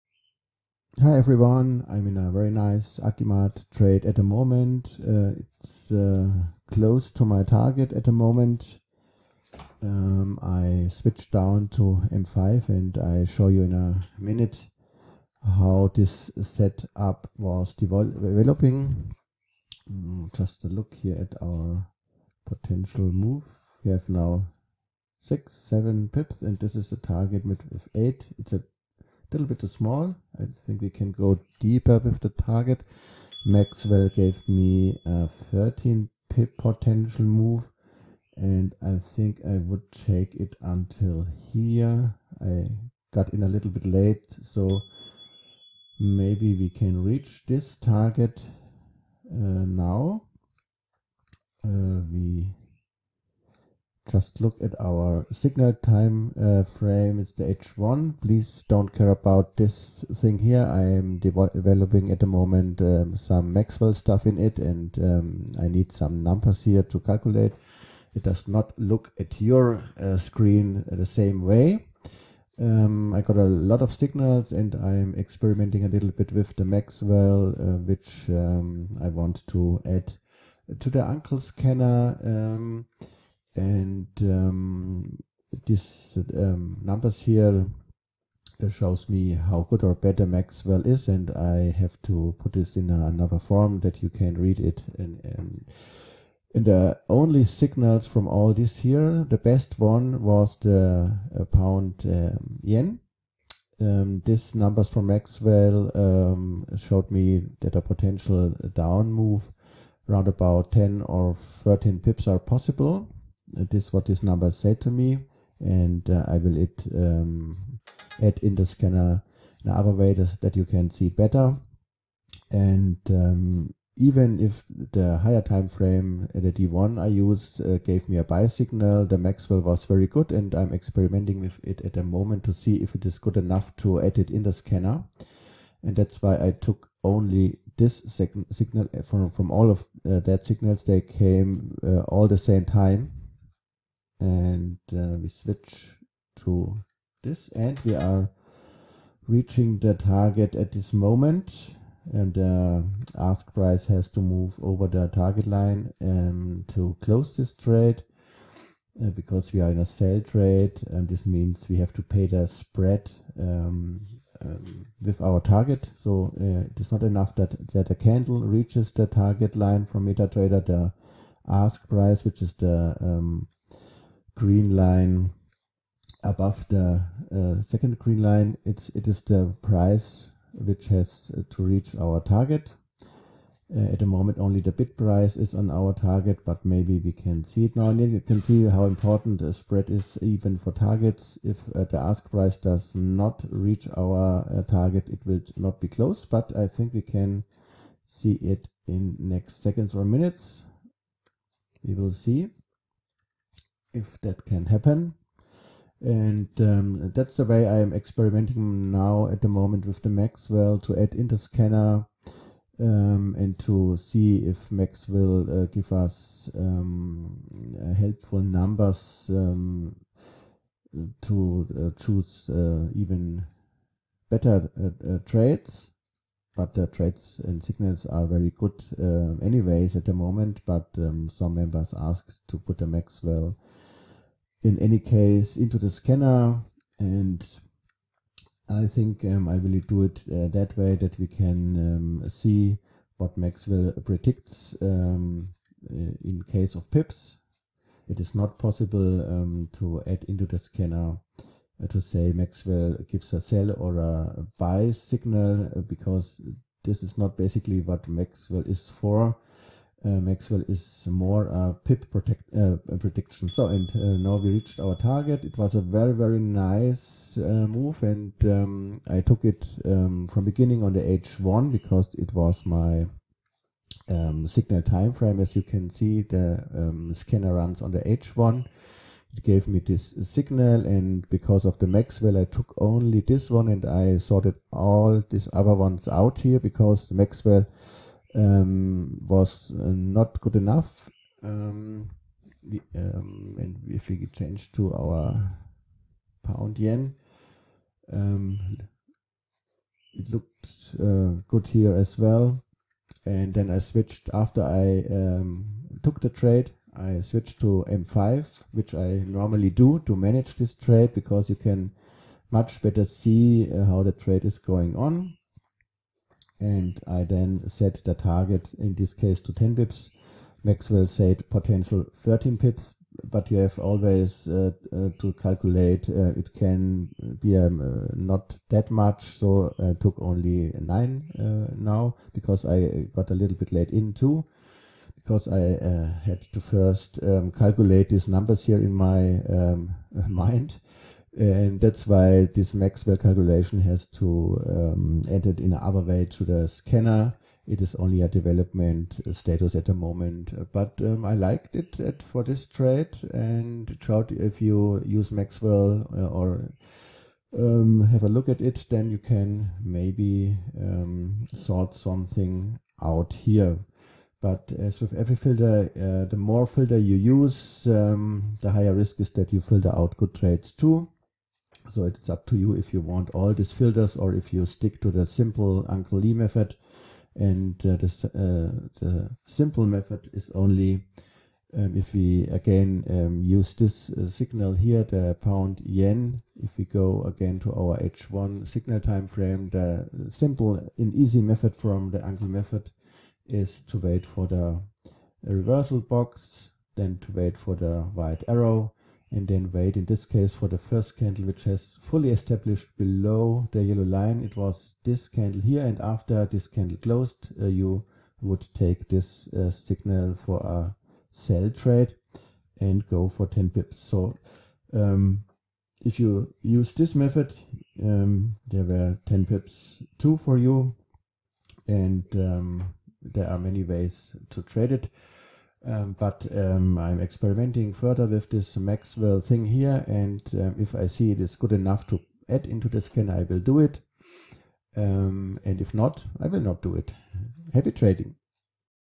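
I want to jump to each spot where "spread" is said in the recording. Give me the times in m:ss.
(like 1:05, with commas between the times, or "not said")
2:42, 3:09.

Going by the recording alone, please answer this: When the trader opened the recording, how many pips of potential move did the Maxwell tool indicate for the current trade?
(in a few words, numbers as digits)
13.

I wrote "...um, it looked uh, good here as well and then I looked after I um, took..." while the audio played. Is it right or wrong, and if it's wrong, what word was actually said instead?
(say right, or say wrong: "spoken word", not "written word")
wrong: "switched", not "looked".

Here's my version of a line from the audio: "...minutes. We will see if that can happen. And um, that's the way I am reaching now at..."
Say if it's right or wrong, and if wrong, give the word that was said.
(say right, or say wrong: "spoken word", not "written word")
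wrong: "experimenting", not "reaching".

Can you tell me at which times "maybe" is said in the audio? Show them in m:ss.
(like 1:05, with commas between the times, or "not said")
0:45, 3:06, 5:59.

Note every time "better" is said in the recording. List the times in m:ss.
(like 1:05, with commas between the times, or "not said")
1:29, 2:01, 3:44, 5:12.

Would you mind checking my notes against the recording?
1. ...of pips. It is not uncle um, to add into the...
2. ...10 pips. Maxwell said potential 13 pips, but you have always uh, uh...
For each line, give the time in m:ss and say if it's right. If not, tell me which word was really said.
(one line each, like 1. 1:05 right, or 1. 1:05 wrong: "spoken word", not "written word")
1. 4:06 wrong: "possible", not "uncle"
2. 5:19 right.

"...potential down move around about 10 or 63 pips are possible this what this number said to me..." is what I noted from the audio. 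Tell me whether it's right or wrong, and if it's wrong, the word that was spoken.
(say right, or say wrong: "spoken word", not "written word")
wrong: "13", not "63".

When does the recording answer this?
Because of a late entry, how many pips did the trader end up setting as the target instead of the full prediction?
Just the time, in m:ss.
5:30.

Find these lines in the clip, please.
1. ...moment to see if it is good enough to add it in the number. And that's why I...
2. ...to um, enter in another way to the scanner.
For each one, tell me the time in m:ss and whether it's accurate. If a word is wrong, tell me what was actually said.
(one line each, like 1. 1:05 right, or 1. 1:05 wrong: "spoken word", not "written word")
1. 2:12 wrong: "scanner", not "number"
2. 5:44 right.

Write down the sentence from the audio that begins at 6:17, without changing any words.
And uh, uh, the, simple method is only um, if we again um, use this uh, signal here, the pound yen.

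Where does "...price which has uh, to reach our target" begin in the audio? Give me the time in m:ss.
2:59.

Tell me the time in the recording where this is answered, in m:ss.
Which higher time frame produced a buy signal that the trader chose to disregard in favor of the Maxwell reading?
2:06.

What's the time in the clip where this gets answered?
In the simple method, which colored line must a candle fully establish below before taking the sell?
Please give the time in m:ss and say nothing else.
6:43.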